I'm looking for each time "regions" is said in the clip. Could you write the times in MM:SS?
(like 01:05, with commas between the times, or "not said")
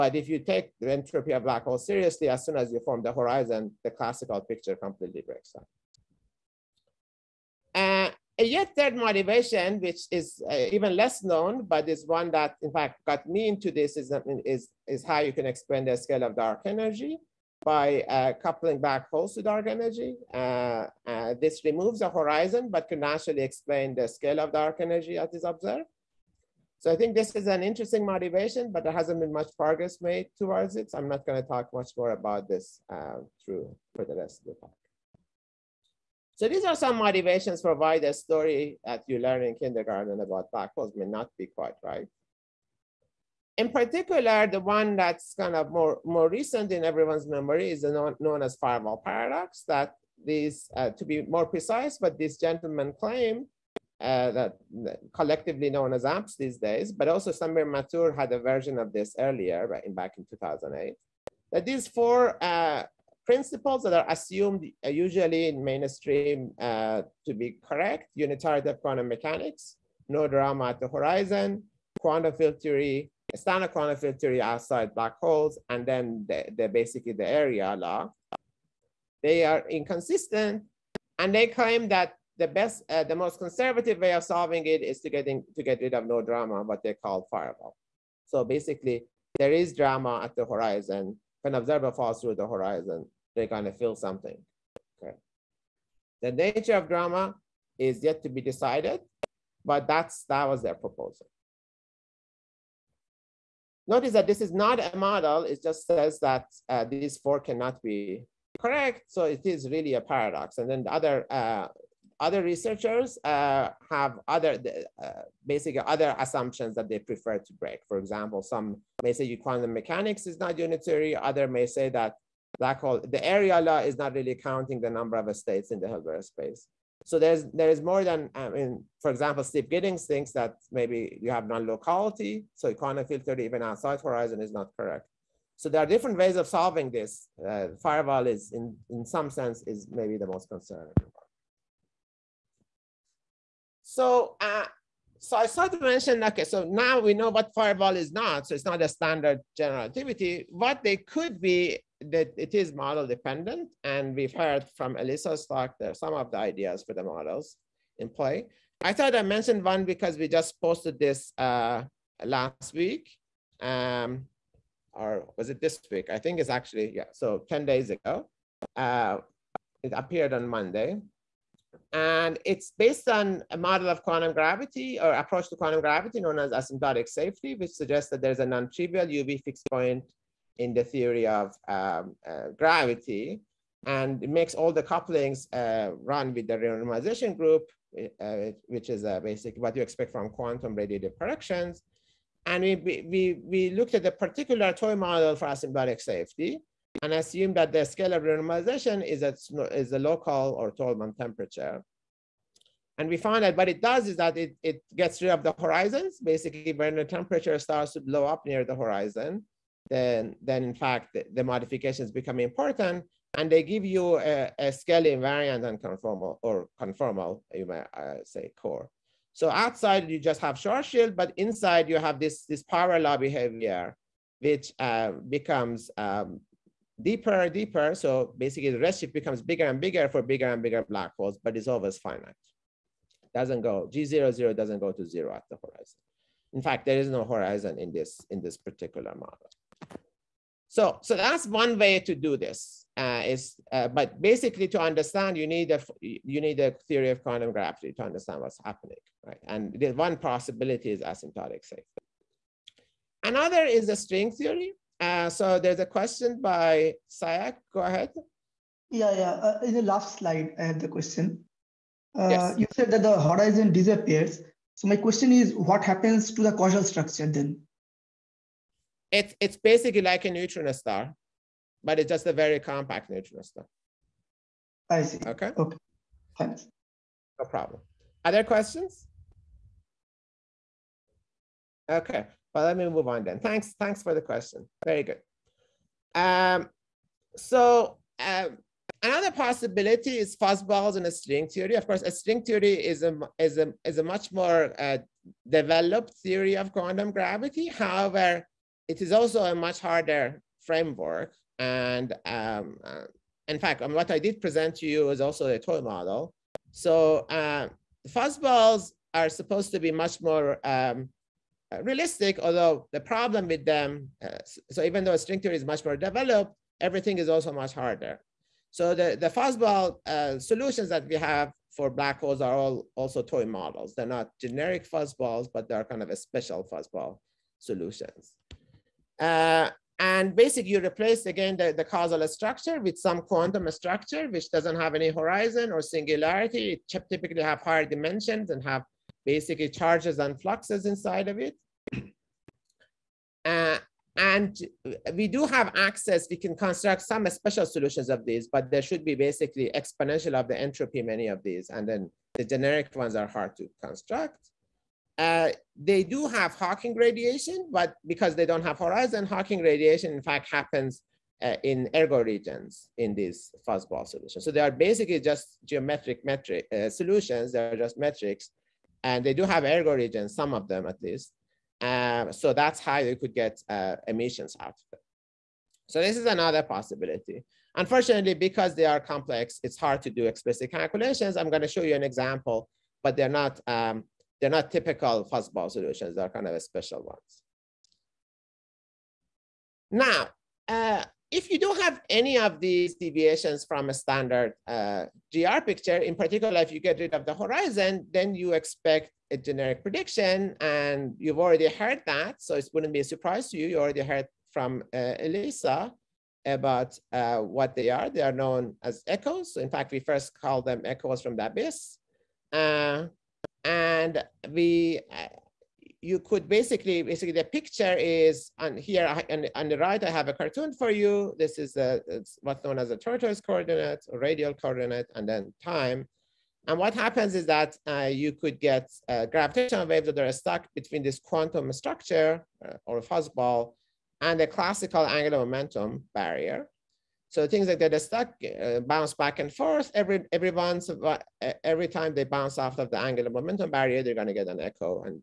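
06:02, 06:09.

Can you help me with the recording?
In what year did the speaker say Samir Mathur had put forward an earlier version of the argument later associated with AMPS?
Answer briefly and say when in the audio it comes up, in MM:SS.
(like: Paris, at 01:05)
2008, at 01:00.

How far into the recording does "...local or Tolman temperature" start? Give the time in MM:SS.
03:19.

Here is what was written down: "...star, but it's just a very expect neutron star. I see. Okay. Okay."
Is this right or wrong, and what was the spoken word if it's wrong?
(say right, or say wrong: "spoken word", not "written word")
wrong: "compact", not "expect".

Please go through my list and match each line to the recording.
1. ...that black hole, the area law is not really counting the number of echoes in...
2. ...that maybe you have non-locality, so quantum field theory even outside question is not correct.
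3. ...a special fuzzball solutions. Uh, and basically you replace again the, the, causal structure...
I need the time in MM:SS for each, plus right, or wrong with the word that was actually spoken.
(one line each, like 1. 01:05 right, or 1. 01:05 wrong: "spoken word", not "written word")
1. 02:01 wrong: "states", not "echoes"
2. 02:10 wrong: "horizon", not "question"
3. 05:26 right.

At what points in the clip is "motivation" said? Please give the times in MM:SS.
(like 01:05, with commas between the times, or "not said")
00:08, 00:28, 00:36.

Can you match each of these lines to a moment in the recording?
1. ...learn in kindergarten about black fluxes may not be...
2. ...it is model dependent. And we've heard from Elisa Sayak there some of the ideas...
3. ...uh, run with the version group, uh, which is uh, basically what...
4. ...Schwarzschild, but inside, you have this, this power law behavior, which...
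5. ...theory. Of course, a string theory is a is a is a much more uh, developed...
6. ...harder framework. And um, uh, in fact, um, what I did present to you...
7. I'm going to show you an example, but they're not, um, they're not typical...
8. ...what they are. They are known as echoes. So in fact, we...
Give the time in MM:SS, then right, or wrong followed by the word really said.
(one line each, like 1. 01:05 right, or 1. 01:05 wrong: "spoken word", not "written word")
1. 00:39 wrong: "holes", not "fluxes"
2. 02:32 wrong: "Stark", not "Sayak"
3. 03:05 wrong: "renormalization", not "version"
4. 03:40 right
5. 04:51 right
6. 04:59 right
7. 06:21 right
8. 06:47 right.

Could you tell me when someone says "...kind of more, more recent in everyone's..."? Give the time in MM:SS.
00:45.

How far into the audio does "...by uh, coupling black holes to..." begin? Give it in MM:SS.
00:17.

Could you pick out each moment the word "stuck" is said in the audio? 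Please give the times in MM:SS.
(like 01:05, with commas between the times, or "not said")
07:10, 07:17.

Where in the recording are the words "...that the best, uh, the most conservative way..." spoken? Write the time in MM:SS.
01:21.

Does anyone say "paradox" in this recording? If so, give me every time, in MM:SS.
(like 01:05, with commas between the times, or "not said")
00:49, 01:50.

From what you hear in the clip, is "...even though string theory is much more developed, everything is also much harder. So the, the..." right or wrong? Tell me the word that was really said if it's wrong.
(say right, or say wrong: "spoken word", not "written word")
right.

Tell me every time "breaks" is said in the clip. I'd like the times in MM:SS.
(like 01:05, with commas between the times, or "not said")
00:05, 01:57.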